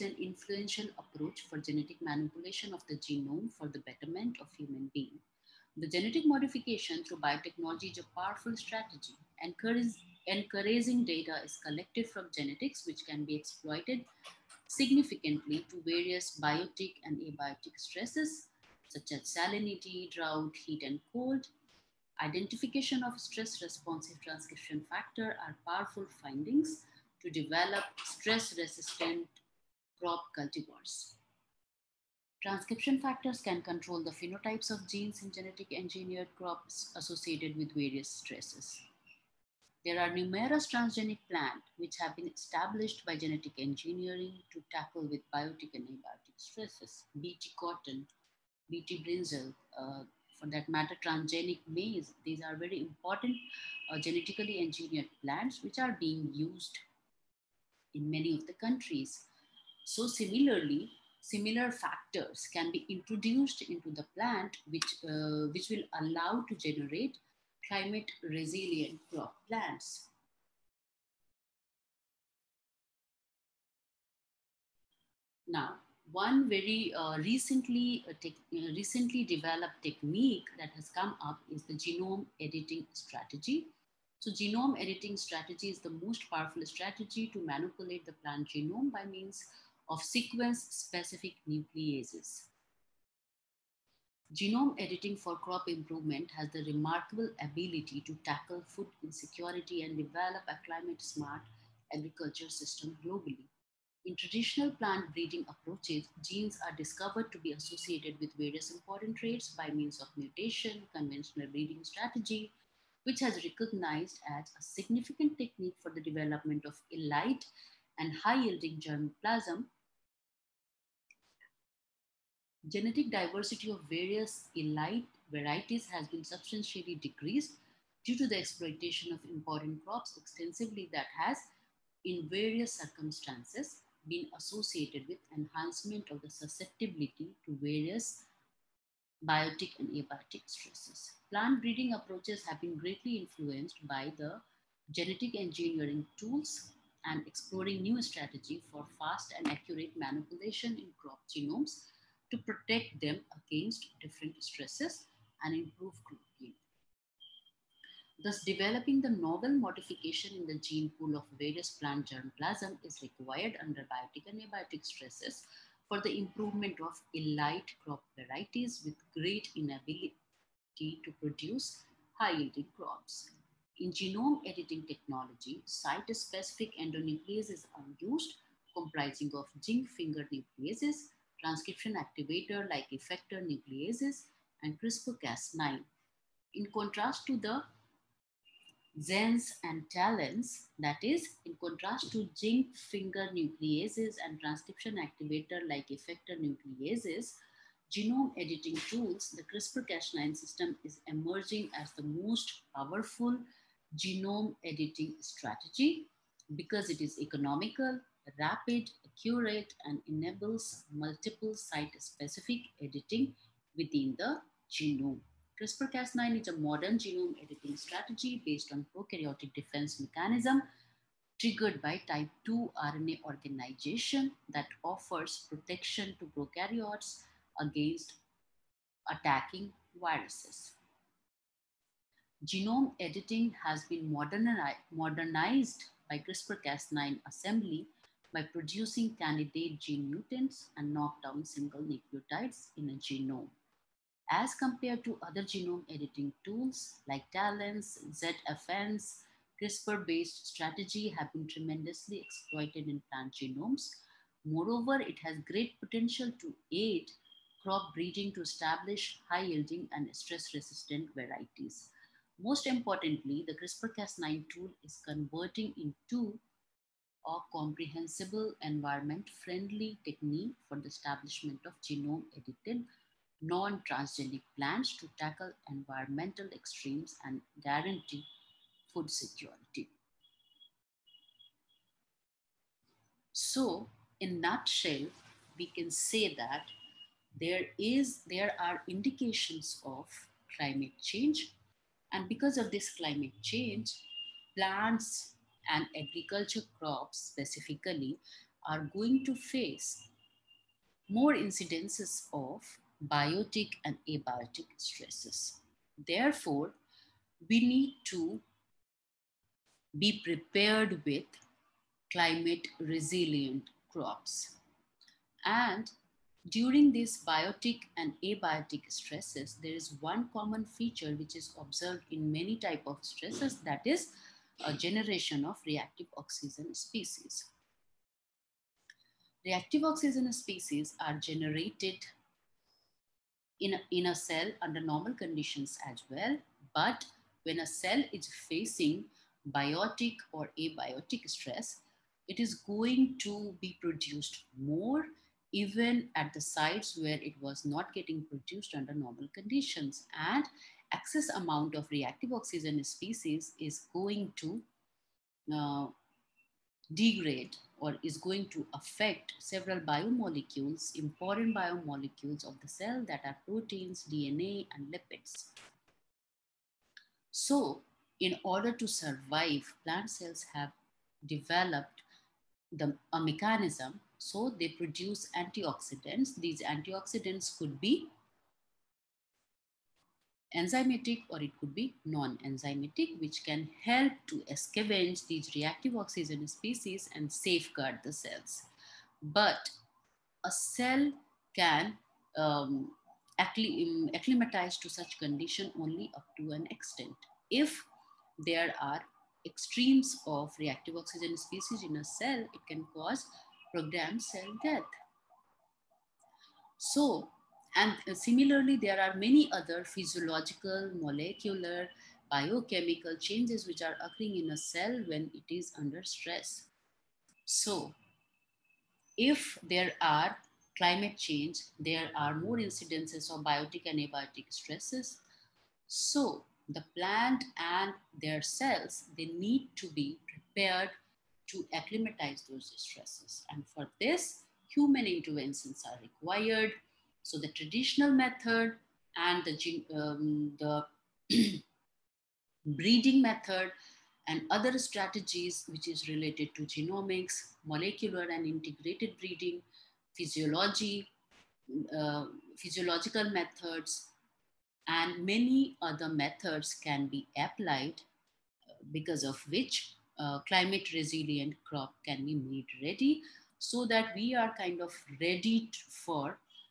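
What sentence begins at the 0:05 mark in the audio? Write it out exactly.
The genetic modification through biotechnology is a powerful strategy.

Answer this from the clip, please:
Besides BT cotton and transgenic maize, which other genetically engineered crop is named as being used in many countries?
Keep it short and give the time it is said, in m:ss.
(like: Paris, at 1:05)
BT brinjal, at 0:48.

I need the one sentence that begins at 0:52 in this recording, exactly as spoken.
These are very important uh, genetically engineered plants which are being used in many of the countries.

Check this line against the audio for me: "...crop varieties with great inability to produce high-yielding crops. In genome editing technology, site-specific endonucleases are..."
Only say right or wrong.
right.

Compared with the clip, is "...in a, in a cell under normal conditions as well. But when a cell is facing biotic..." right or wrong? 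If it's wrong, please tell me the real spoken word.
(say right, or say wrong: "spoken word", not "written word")
right.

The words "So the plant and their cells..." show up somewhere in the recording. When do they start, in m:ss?
7:05.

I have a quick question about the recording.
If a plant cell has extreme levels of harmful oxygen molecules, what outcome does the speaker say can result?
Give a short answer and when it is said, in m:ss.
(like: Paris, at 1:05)
programmed cell death, at 6:43.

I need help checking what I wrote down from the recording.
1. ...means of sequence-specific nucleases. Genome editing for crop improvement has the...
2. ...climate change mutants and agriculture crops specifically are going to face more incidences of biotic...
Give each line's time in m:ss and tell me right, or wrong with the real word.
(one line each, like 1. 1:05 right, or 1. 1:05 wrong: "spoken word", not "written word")
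1. 1:29 right
2. 4:52 wrong: "plants", not "mutants".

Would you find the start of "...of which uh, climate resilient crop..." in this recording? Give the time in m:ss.
7:39.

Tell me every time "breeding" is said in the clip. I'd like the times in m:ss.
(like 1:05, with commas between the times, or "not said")
1:45, 1:51, 2:21, 4:17, 7:22, 7:29.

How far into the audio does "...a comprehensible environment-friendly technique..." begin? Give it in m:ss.
4:27.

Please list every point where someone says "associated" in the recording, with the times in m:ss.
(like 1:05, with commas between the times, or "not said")
0:36, 1:47, 2:14.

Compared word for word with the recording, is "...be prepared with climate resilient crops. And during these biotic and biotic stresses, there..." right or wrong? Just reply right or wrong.
wrong.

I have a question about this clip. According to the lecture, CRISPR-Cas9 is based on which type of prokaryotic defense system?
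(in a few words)
type 2.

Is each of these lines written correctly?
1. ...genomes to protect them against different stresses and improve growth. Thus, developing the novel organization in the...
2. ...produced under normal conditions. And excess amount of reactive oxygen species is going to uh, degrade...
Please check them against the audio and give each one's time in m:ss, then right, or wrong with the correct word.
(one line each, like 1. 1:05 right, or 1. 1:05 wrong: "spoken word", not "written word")
1. 2:31 wrong: "modification", not "organization"
2. 5:48 right.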